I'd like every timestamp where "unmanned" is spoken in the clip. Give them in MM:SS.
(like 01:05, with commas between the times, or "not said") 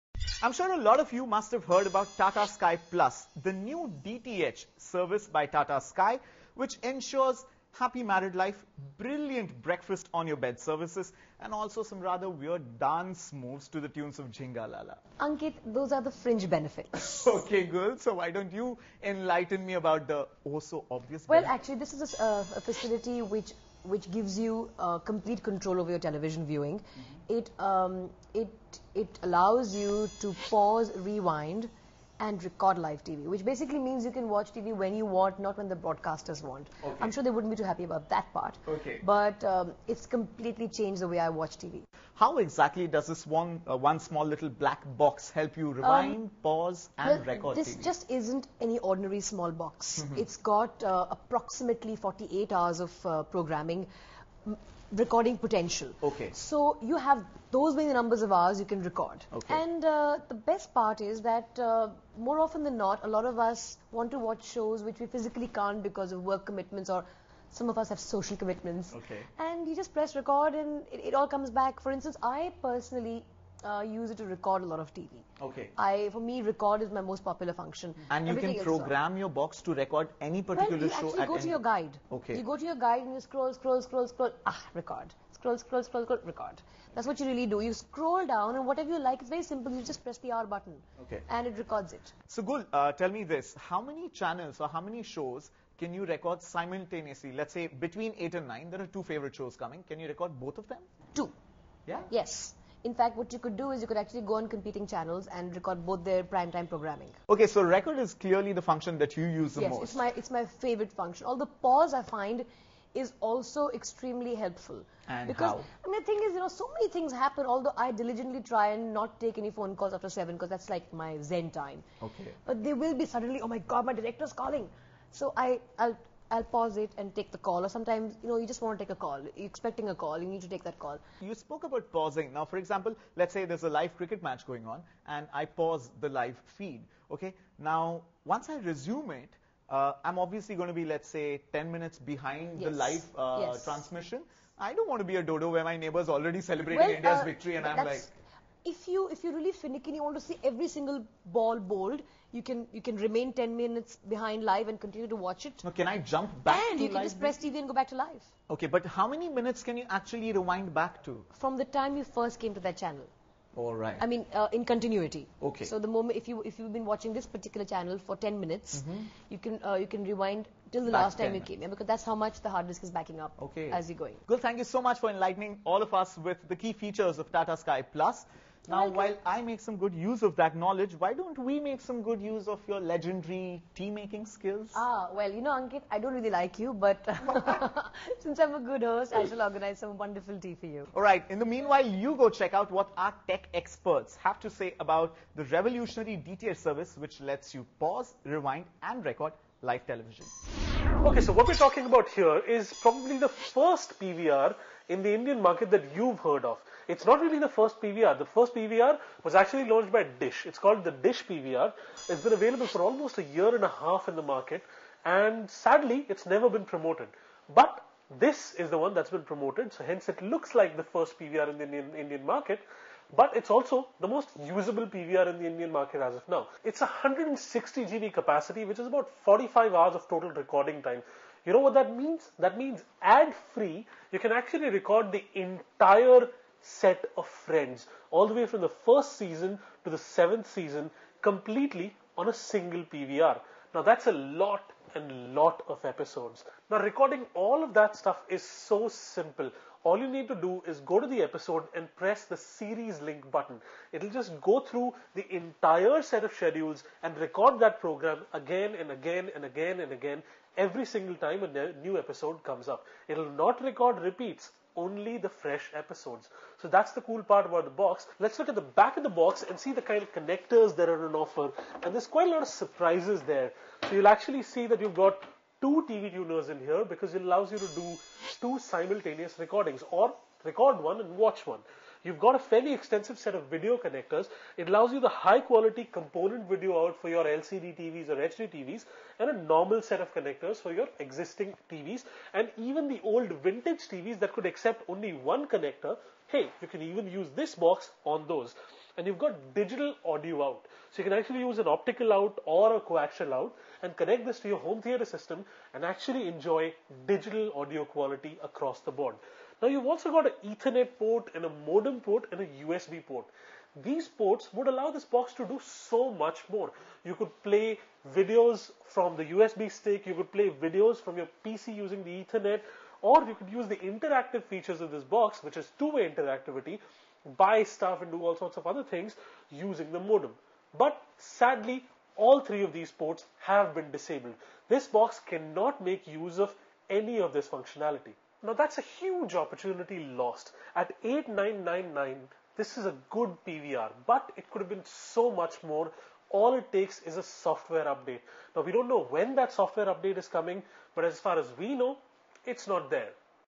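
not said.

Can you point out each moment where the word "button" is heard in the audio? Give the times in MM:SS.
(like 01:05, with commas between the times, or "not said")
01:30, 04:13.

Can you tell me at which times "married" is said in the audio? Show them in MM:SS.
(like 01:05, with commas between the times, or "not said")
00:08.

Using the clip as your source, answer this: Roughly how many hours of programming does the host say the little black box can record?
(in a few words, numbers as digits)
48 hours.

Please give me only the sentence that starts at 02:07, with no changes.
Or sometimes, you know, you just want to take a call.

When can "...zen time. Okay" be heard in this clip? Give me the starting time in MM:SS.
02:01.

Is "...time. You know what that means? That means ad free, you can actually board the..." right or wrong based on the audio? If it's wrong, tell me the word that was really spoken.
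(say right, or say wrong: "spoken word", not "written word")
wrong: "record", not "board".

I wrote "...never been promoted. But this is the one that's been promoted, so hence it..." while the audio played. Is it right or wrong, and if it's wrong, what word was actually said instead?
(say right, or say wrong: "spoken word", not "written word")
right.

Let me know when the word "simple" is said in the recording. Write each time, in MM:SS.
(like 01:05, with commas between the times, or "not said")
01:29, 04:08.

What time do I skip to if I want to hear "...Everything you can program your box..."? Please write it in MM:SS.
01:18.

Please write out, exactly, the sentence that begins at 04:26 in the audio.
So that's the cool part about the box.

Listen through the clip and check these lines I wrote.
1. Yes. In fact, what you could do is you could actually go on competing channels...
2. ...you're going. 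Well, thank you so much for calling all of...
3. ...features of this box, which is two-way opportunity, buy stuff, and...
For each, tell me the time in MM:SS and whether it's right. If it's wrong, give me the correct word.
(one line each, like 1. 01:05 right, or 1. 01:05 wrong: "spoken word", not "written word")
1. 01:42 right
2. 02:53 wrong: "enlightening", not "calling"
3. 05:24 wrong: "interactivity", not "opportunity".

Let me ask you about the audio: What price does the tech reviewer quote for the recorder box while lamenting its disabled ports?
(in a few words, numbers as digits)
8999.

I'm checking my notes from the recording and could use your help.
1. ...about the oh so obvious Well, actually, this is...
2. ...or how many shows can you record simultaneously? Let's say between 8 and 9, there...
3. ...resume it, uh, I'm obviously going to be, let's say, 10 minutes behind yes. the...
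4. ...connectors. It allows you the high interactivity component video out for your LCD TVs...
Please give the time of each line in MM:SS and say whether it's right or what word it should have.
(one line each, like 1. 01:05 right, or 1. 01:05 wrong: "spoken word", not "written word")
1. 00:19 right
2. 01:34 right
3. 02:18 right
4. 04:43 wrong: "quality", not "interactivity".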